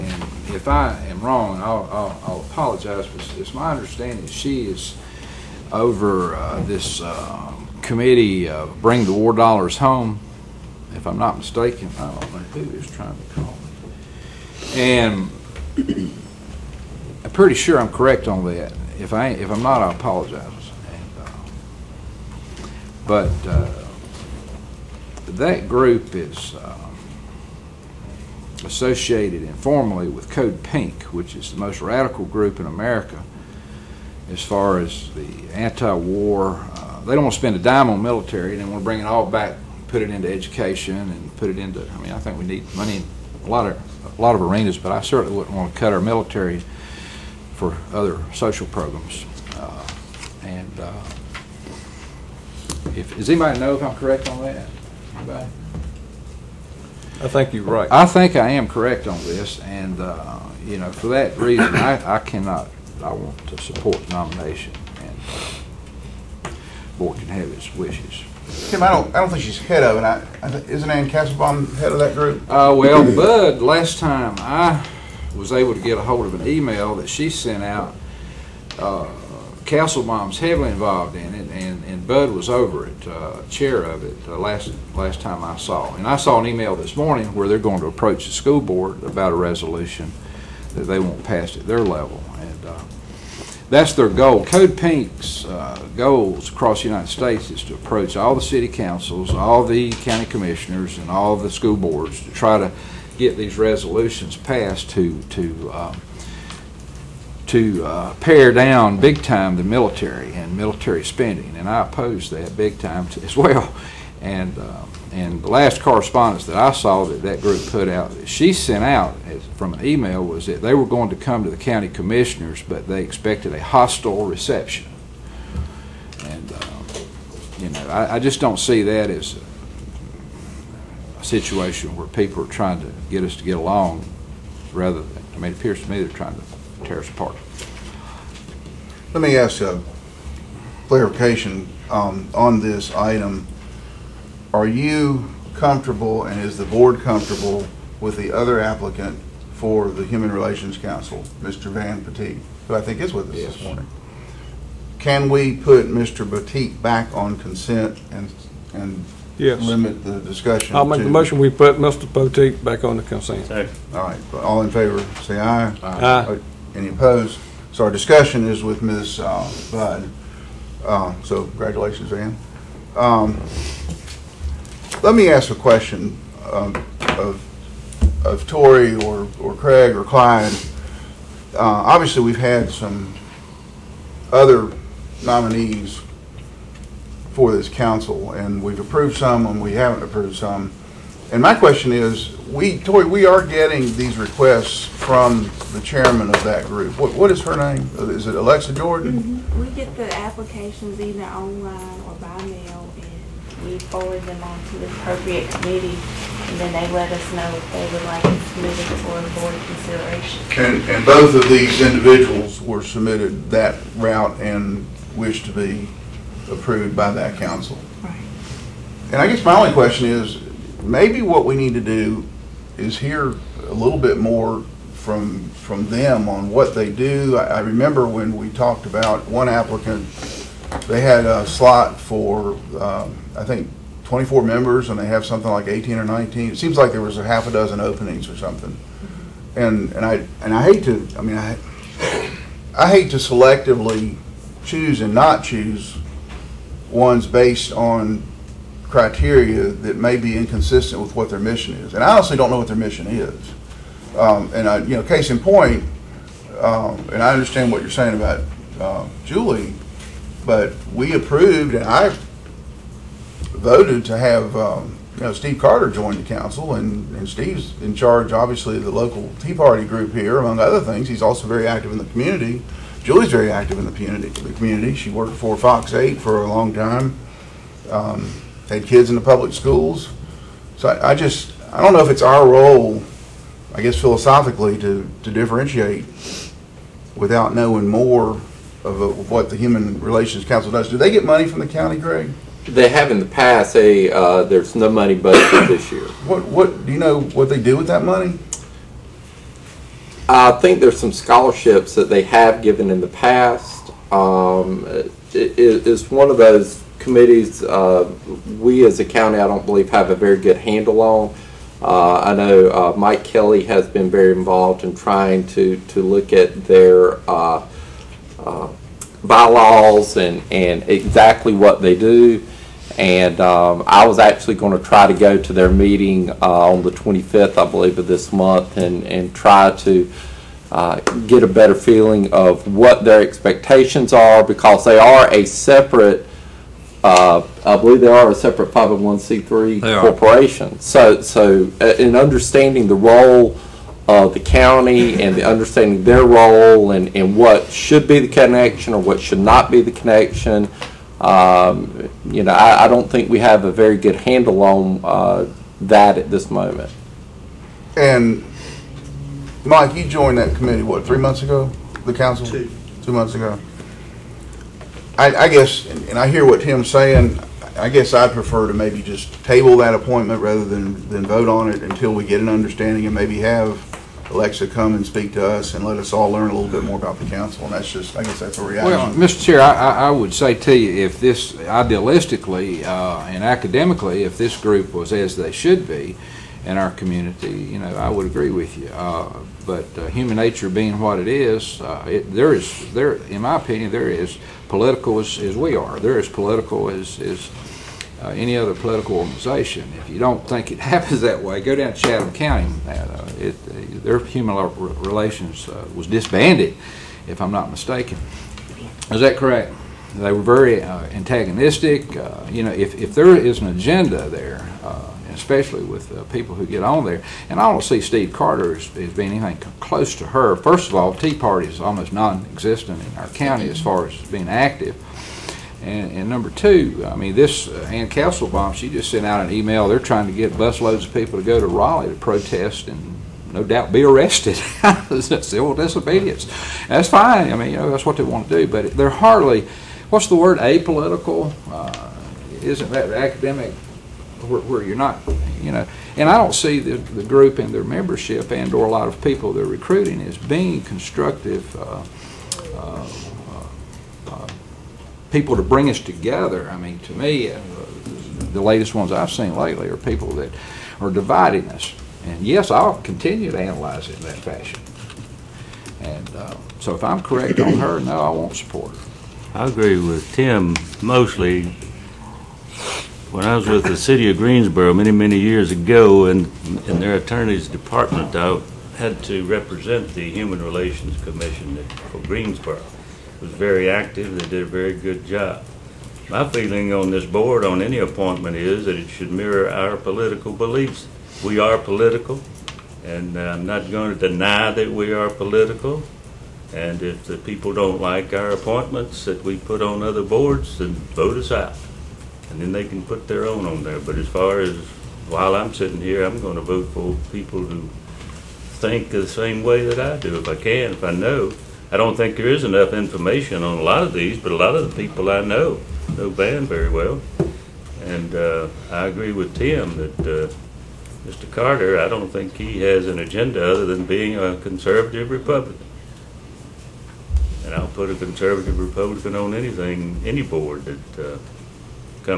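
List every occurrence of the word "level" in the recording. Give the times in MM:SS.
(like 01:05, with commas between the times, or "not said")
01:31.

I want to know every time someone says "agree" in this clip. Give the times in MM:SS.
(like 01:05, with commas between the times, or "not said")
06:28, 07:49, 08:39.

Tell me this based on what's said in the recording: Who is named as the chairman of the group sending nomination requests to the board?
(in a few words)
Alexa Jordan.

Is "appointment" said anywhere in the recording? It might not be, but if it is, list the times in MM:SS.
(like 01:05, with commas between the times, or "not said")
06:09, 08:07, 08:18.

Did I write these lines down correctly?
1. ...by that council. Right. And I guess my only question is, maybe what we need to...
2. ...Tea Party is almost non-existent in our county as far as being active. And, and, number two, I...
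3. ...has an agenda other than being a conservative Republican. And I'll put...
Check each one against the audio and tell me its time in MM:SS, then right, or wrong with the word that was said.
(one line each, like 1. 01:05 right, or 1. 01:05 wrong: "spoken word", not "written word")
1. 03:36 right
2. 07:01 right
3. 08:42 right.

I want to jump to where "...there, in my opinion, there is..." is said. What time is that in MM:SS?
06:32.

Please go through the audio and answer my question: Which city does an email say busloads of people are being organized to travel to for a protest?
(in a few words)
Raleigh.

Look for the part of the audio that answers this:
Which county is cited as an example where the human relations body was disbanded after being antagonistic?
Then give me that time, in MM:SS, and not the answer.
06:41.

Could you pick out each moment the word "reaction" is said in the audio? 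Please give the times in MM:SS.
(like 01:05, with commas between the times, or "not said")
06:18.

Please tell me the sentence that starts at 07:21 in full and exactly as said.
Uh, isn't that academic where, where, you're not, you know?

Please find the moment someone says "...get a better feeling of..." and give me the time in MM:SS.
05:31.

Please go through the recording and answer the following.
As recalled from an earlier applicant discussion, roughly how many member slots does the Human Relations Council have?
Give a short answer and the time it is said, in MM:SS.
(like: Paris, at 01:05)
24, at 03:54.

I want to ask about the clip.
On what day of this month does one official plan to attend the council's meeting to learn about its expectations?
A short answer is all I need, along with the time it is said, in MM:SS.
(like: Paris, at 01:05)
25th, at 05:26.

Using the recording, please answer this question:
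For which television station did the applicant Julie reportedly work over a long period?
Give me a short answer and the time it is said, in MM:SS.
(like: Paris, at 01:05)
Fox 8, at 04:35.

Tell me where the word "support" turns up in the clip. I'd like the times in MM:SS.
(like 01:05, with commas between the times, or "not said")
01:03, 07:48.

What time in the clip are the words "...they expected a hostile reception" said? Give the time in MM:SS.
02:02.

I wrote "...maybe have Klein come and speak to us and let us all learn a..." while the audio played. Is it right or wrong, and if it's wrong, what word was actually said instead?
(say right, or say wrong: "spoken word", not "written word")
wrong: "Alexa", not "Klein".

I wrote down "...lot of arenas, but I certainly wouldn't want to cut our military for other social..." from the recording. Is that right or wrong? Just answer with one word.
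right.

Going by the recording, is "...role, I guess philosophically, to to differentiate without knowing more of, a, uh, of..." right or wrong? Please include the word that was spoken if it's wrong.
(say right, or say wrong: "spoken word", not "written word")
right.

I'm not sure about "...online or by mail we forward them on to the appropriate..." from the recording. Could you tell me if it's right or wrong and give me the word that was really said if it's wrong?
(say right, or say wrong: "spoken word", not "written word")
right.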